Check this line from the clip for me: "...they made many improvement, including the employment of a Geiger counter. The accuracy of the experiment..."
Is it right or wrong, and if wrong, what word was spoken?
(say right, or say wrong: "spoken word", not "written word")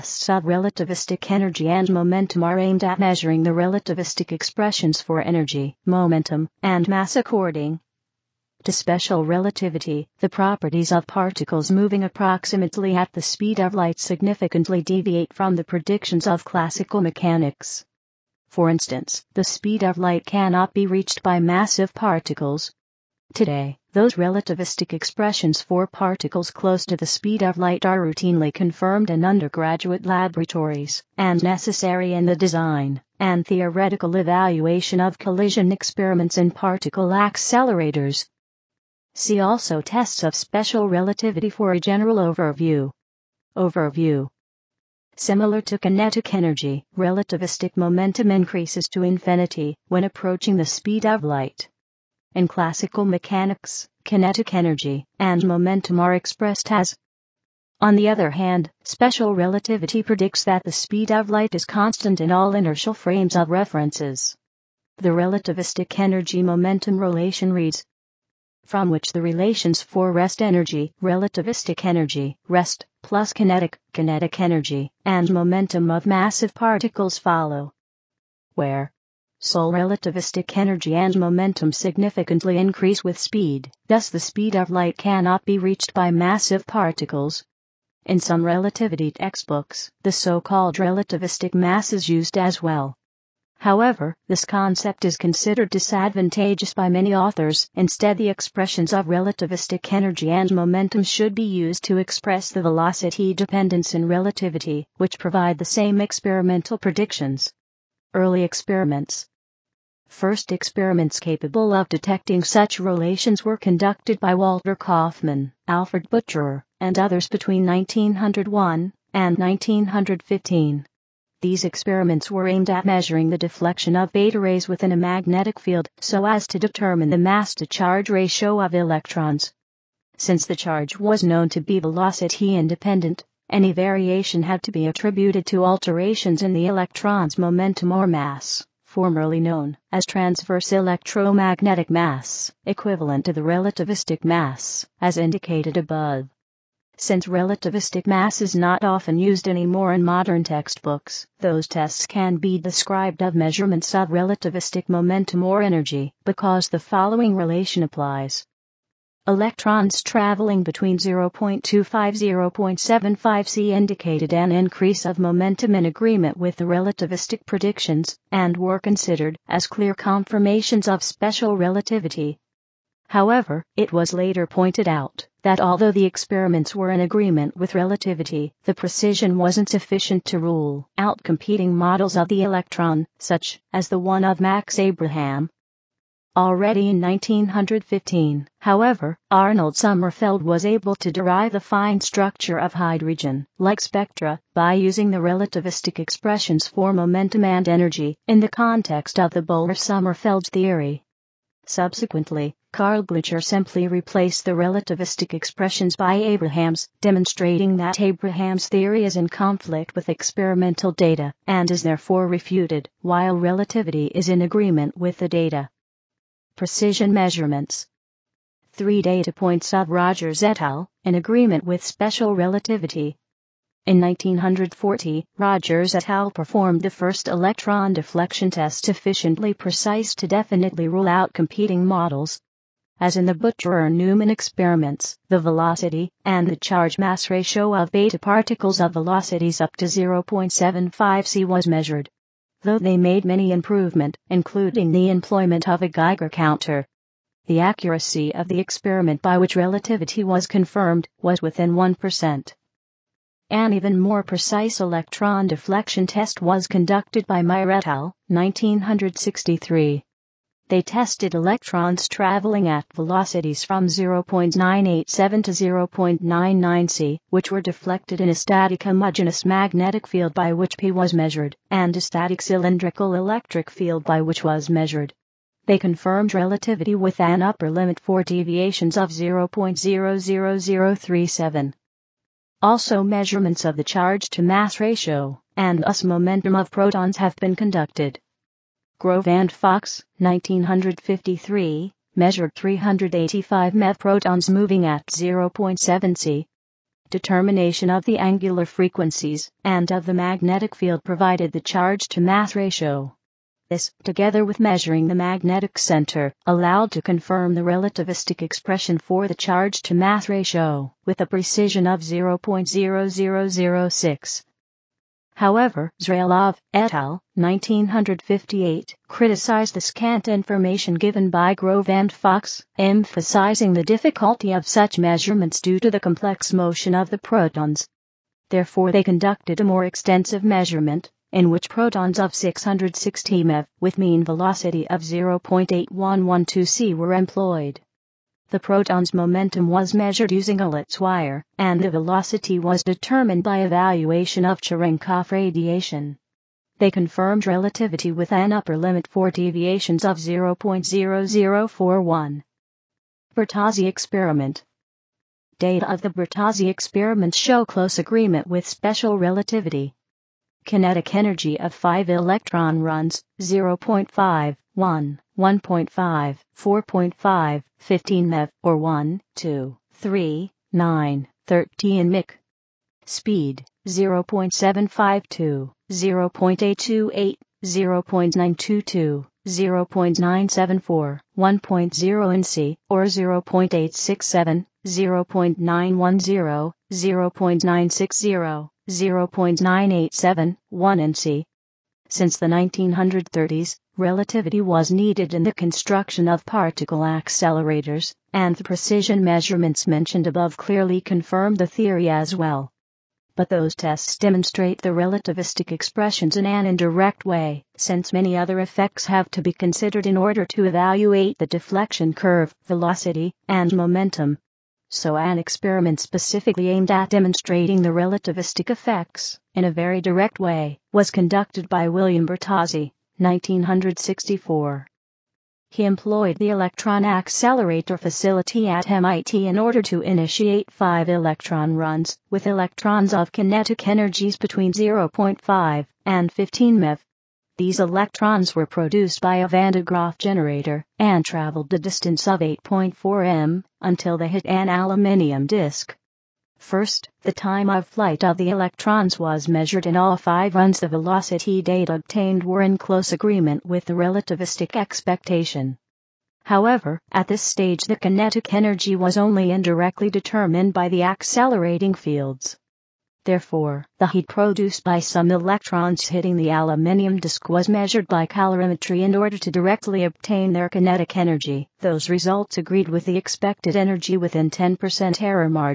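right.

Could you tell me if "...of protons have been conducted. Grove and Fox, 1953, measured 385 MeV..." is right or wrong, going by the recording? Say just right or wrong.
right.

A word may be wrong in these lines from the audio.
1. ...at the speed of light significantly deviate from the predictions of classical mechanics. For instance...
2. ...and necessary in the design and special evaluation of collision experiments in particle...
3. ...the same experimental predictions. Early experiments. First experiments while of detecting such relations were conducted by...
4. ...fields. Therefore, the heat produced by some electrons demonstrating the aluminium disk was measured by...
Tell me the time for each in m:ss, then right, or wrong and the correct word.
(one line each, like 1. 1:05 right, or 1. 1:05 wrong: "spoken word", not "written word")
1. 0:12 right
2. 0:31 wrong: "theoretical", not "special"
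3. 1:45 wrong: "capable", not "while"
4. 7:41 wrong: "hitting", not "demonstrating".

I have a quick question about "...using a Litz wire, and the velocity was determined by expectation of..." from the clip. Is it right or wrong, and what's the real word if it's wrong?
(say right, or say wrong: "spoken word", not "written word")
wrong: "evaluation", not "expectation".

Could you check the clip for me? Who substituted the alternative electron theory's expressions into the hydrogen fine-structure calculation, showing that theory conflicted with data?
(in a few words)
Karl Glitscher.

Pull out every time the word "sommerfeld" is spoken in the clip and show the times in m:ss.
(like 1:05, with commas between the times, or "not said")
3:09, 3:19.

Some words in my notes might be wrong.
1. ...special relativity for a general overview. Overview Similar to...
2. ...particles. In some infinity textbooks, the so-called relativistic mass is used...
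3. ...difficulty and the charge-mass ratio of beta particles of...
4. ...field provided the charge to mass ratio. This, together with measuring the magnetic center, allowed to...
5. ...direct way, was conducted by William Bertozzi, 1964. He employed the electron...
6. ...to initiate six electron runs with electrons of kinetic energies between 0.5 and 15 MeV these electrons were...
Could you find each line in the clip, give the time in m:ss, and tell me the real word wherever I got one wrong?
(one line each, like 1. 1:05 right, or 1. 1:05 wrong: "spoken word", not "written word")
1. 0:40 right
2. 1:26 wrong: "relativity", not "infinity"
3. 3:55 wrong: "velocity", not "difficulty"
4. 5:00 right
5. 7:00 right
6. 7:09 wrong: "five", not "six".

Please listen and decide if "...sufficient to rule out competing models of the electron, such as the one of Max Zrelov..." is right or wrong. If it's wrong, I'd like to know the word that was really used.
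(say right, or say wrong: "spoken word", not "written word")
wrong: "Abraham", not "Zrelov".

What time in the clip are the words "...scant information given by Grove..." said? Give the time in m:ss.
5:19.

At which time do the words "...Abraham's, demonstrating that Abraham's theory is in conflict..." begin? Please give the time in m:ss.
3:26.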